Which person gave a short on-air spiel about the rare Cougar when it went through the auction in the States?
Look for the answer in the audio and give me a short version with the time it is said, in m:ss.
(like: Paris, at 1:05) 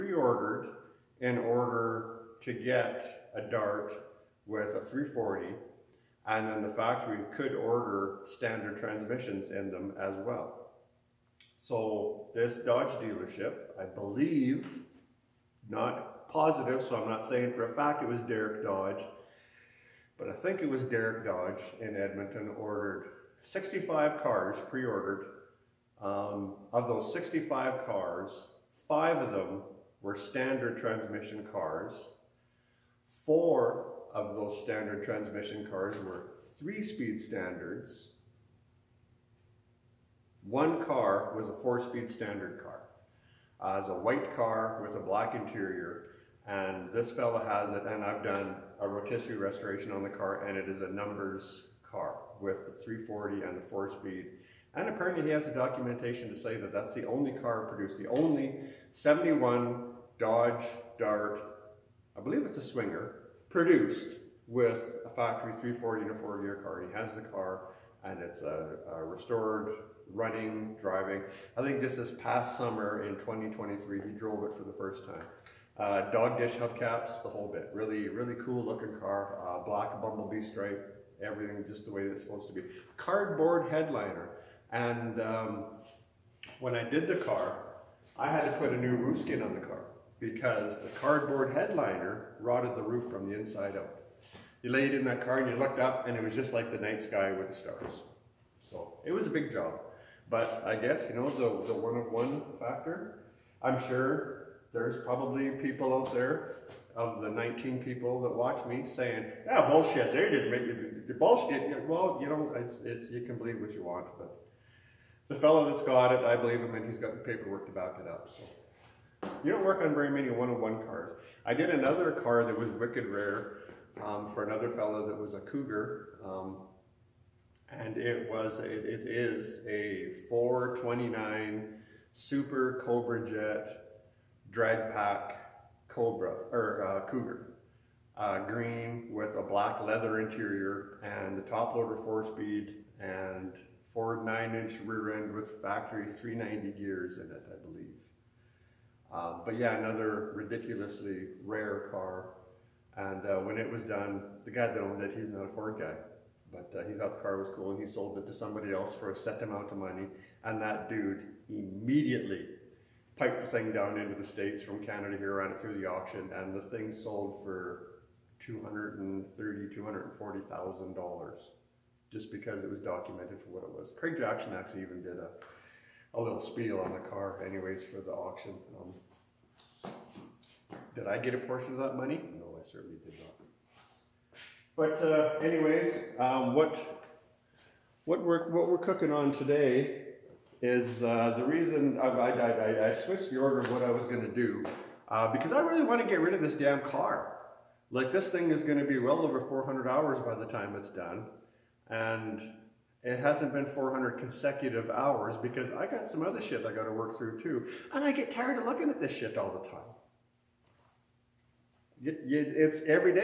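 Craig Jackson, at 2:53.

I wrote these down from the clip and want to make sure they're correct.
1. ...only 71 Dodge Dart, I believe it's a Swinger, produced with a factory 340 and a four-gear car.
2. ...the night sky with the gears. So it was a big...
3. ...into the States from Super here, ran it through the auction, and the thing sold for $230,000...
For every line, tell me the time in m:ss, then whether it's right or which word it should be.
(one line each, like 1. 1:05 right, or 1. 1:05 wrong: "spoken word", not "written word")
1. 0:58 right
2. 1:36 wrong: "stars", not "gears"
3. 2:43 wrong: "Canada", not "Super".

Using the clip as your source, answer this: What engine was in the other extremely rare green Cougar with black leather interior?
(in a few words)
429 Super Cobra Jet.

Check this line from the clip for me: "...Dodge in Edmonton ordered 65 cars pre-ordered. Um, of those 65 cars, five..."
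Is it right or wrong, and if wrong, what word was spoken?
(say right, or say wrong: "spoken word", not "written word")
right.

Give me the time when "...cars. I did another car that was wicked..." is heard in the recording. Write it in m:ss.
2:00.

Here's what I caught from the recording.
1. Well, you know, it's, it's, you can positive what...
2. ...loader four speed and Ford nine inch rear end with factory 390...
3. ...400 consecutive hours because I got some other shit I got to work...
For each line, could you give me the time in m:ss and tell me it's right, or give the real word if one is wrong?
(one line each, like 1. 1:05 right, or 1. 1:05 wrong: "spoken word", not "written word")
1. 1:51 wrong: "believe", not "positive"
2. 2:21 right
3. 3:23 right.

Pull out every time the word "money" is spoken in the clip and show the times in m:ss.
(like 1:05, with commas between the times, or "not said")
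2:39, 3:01.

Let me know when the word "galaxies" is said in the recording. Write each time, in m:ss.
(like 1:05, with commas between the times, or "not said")
not said.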